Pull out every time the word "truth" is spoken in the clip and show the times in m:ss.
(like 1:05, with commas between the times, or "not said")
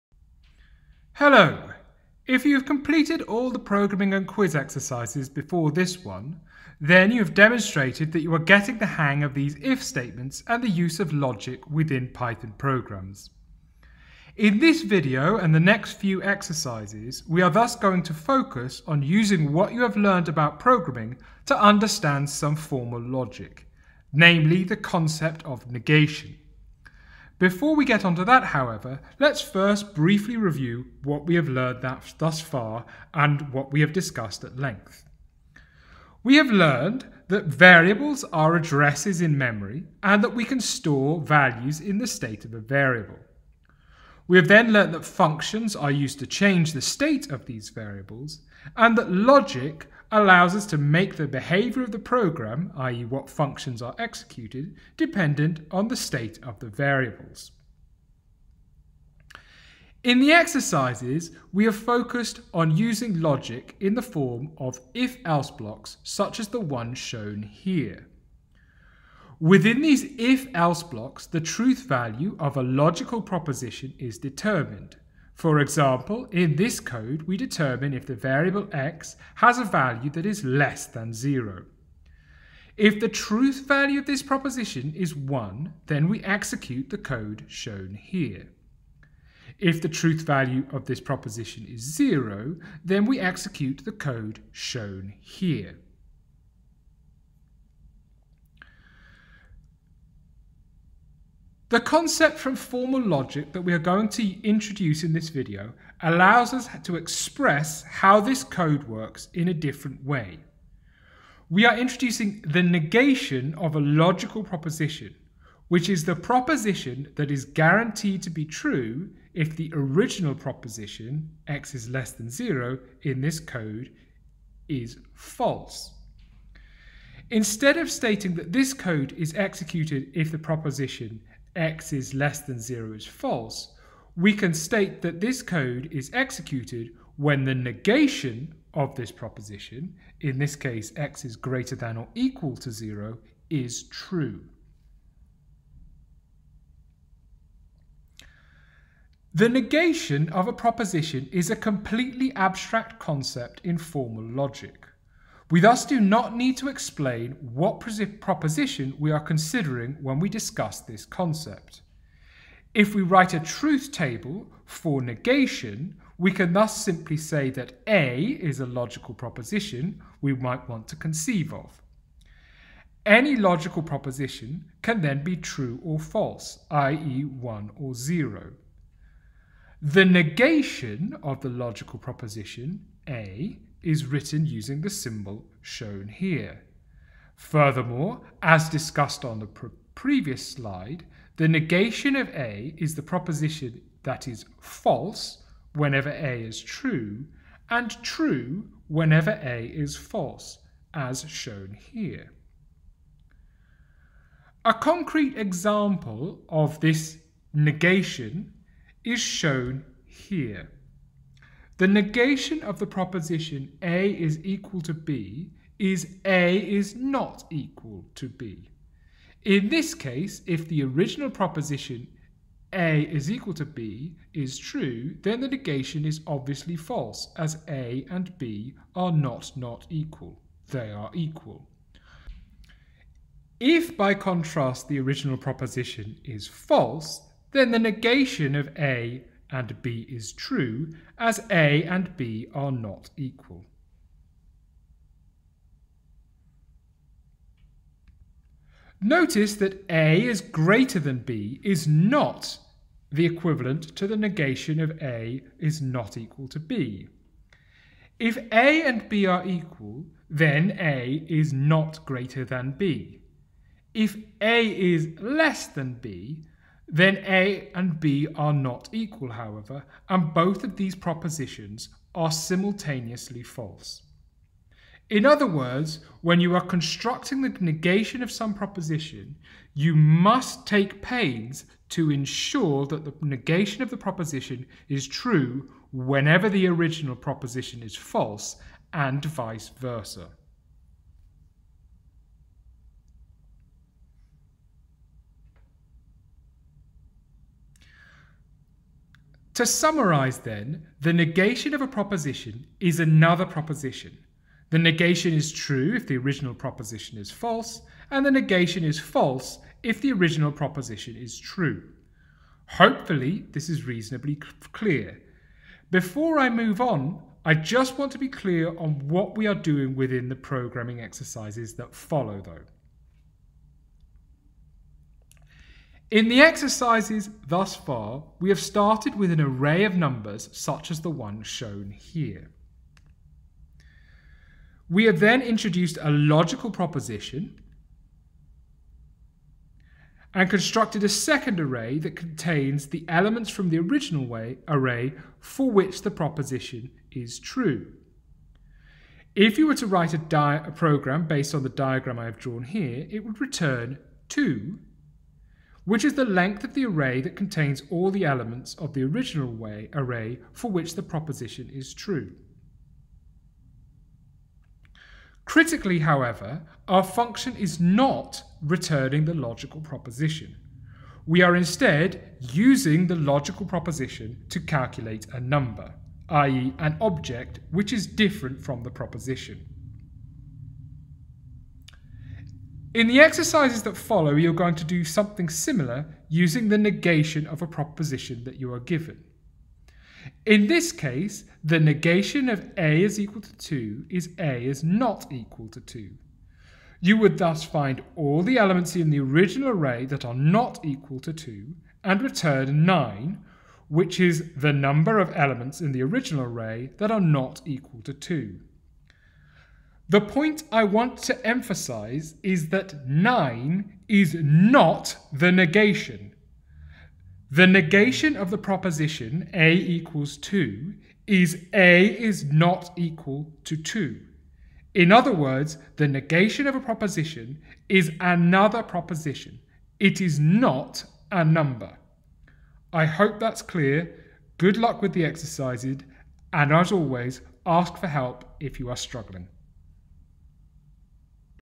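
1:11, 1:23, 1:29, 2:43.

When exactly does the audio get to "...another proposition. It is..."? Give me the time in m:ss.
7:08.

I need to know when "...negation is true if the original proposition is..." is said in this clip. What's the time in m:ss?
5:04.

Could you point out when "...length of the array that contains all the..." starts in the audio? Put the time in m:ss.
5:56.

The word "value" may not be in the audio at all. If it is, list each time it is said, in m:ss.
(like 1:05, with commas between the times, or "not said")
0:41, 1:11, 1:19, 1:23, 1:30.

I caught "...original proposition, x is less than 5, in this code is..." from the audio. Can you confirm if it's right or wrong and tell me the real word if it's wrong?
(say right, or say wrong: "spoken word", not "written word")
wrong: "0", not "5".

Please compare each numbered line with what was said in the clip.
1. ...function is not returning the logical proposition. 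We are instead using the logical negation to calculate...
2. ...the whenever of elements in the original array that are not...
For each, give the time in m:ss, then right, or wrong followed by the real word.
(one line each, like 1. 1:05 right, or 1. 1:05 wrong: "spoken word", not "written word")
1. 6:07 wrong: "proposition", not "negation"
2. 6:44 wrong: "number", not "whenever".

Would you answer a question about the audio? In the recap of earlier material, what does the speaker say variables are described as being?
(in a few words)
addresses in memory.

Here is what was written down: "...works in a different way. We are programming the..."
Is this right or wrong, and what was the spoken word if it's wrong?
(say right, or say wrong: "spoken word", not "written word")
wrong: "introducing", not "programming".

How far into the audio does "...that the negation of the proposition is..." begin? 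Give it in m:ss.
4:42.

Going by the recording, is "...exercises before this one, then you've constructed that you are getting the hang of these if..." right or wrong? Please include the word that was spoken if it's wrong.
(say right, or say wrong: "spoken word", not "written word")
wrong: "demonstrated", not "constructed".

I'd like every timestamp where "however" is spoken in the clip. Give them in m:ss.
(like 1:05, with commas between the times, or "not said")
0:28, 4:29, 6:05.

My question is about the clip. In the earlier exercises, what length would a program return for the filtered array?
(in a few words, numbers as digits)
2.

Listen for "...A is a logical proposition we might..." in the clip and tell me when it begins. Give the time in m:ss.
2:47.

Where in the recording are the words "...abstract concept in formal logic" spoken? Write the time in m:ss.
2:32.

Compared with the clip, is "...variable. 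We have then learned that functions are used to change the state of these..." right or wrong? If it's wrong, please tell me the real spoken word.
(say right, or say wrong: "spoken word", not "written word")
right.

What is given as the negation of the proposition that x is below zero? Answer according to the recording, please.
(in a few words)
x is greater than or equal to 0.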